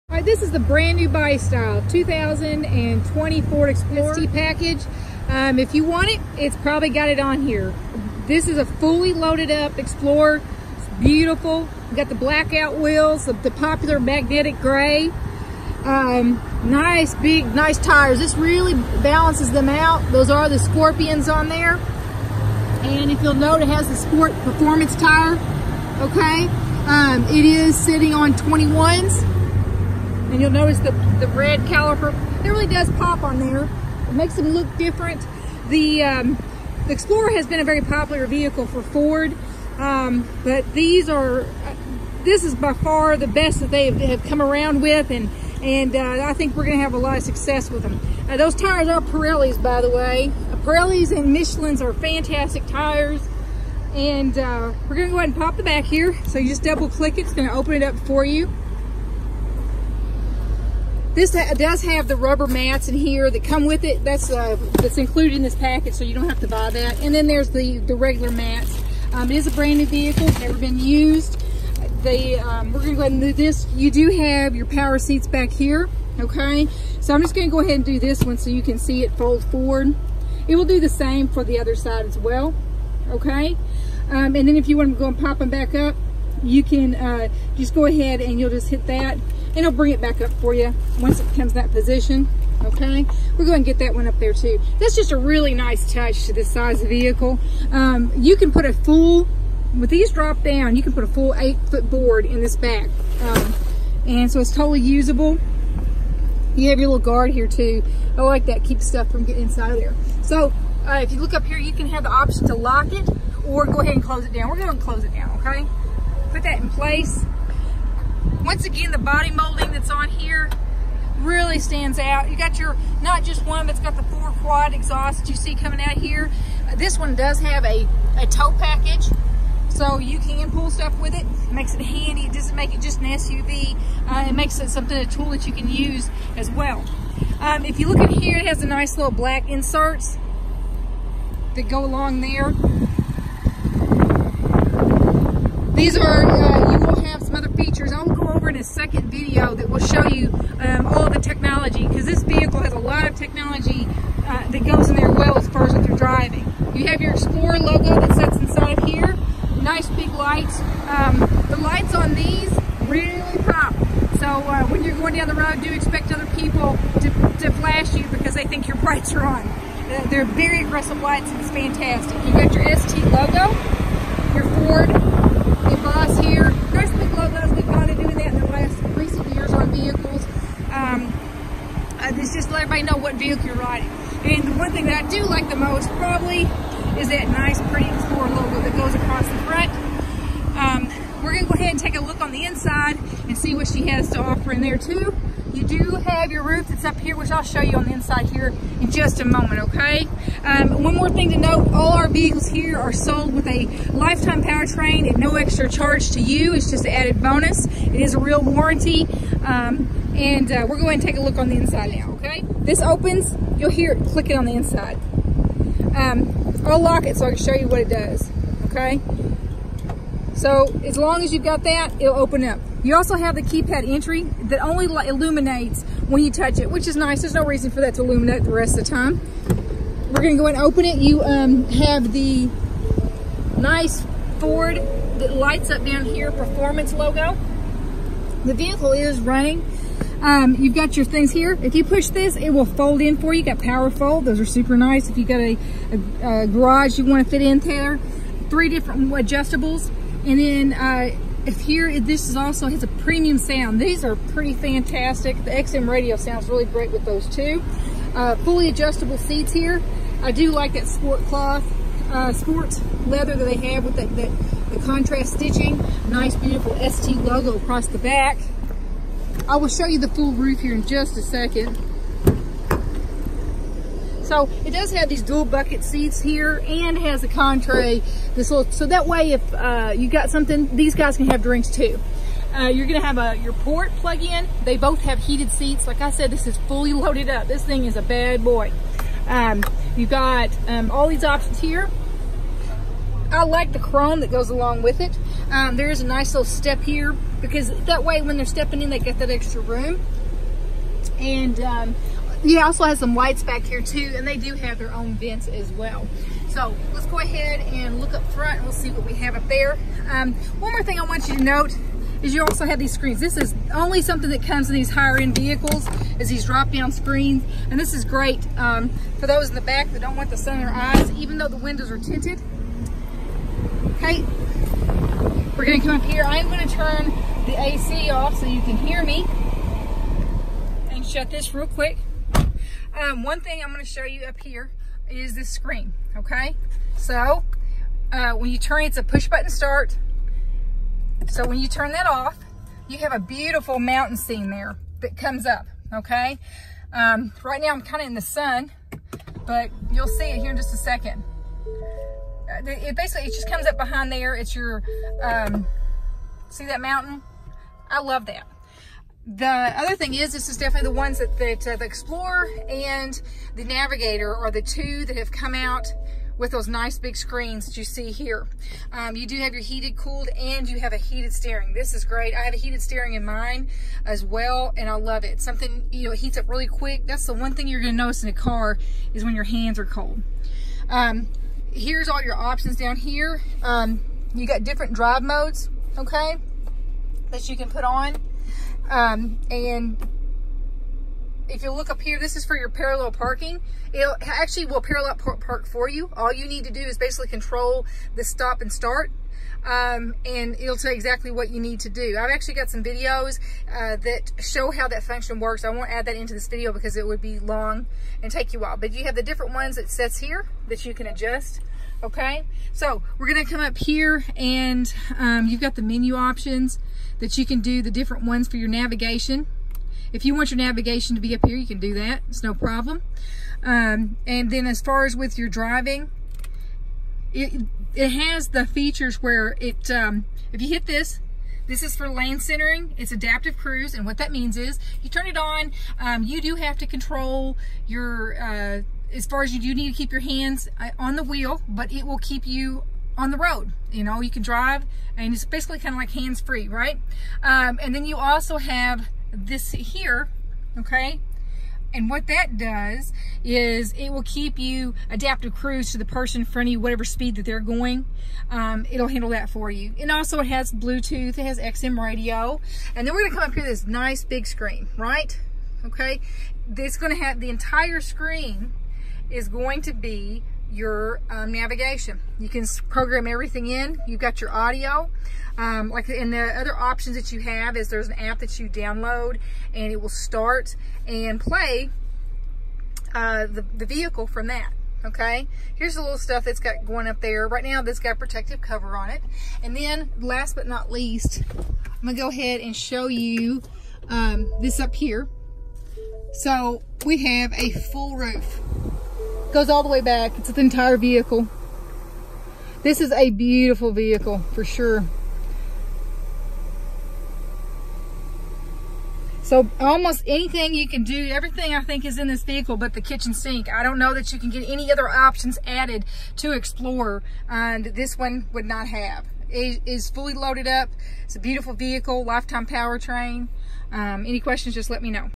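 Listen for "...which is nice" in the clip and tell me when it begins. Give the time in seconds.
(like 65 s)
226 s.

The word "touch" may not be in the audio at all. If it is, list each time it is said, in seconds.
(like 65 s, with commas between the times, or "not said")
95 s, 226 s.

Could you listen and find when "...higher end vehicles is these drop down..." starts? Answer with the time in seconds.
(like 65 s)
314 s.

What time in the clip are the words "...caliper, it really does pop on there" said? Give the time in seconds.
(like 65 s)
31 s.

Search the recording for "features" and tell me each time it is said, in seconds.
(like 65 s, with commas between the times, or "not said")
147 s, 428 s.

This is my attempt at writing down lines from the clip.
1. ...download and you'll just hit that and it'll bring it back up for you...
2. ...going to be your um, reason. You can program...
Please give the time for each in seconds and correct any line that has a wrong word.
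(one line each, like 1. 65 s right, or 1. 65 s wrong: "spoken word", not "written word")
1. 87 s wrong: "ahead", not "download"
2. 469 s wrong: "navigation", not "reason".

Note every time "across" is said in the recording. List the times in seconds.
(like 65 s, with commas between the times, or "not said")
188 s, 267 s.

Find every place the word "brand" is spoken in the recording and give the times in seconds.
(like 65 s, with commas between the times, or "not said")
0 s, 69 s.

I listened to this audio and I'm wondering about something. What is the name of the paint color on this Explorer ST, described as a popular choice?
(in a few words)
Magnetic gray.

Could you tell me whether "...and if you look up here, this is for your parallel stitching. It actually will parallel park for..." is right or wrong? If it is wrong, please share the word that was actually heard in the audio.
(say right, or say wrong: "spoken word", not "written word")
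wrong: "parking", not "stitching".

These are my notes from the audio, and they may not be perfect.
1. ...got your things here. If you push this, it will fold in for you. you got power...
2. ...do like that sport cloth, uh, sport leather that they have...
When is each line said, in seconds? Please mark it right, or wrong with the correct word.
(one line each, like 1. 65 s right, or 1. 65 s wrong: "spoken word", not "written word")
1. 240 s right
2. 260 s right.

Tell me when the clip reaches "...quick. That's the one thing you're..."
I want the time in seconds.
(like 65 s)
376 s.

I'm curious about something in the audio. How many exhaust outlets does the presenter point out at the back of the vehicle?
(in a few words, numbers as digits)
4.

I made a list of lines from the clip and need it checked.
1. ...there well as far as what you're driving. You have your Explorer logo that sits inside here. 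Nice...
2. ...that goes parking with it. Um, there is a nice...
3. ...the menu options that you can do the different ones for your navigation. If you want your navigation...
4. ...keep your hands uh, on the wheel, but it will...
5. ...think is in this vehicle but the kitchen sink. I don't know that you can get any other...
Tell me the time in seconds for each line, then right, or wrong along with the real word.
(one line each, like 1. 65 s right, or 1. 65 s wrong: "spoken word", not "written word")
1. 154 s right
2. 294 s wrong: "along", not "parking"
3. 415 s right
4. 439 s right
5. 511 s right.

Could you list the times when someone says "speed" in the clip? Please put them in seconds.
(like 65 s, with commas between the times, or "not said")
457 s.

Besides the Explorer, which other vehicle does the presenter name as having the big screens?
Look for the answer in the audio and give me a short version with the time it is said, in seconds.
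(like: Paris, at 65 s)
Navigator, at 363 s.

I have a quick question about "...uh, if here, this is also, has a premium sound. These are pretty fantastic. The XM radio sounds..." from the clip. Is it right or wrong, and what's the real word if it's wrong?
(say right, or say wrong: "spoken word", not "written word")
right.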